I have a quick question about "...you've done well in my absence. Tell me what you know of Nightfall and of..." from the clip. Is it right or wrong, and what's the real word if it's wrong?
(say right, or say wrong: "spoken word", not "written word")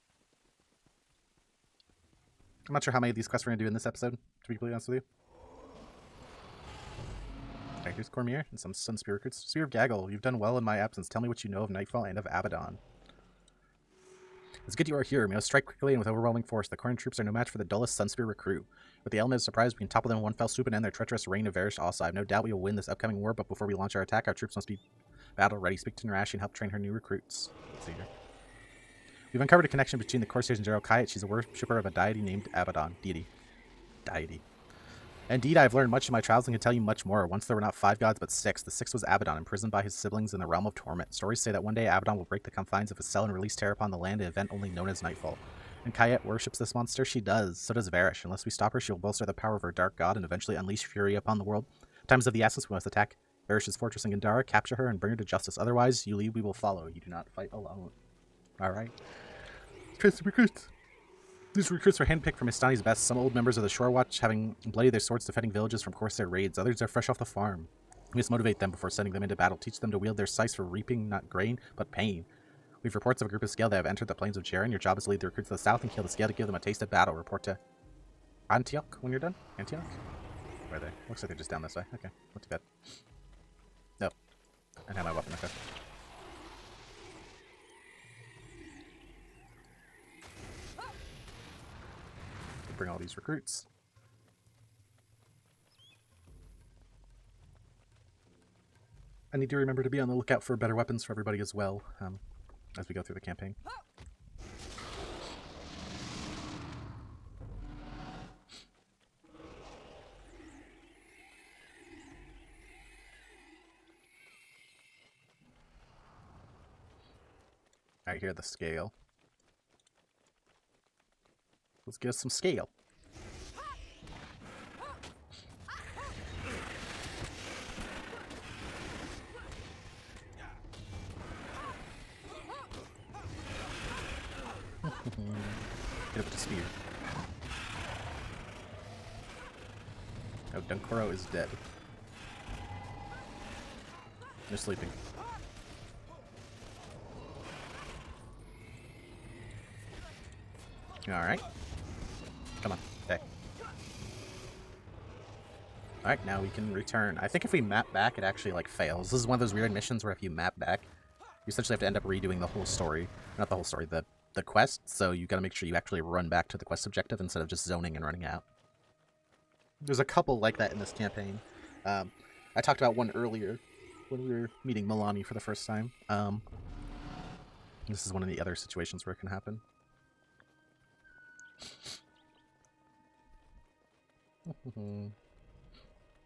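right.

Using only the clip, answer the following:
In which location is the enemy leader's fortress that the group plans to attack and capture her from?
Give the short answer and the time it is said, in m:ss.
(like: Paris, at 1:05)
Gandara, at 0:54.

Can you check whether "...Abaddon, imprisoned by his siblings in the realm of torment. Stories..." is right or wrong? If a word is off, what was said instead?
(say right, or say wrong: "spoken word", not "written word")
right.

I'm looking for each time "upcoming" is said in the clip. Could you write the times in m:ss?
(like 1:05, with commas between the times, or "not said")
0:22.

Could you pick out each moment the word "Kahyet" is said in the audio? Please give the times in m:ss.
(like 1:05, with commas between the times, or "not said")
0:30, 0:45.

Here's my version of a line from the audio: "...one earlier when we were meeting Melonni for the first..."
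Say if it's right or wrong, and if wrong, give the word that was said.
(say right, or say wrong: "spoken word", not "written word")
right.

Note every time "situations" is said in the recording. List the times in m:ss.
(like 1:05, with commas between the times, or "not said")
2:58.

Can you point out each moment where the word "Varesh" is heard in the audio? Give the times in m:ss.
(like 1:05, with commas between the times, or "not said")
0:21, 0:47, 0:53.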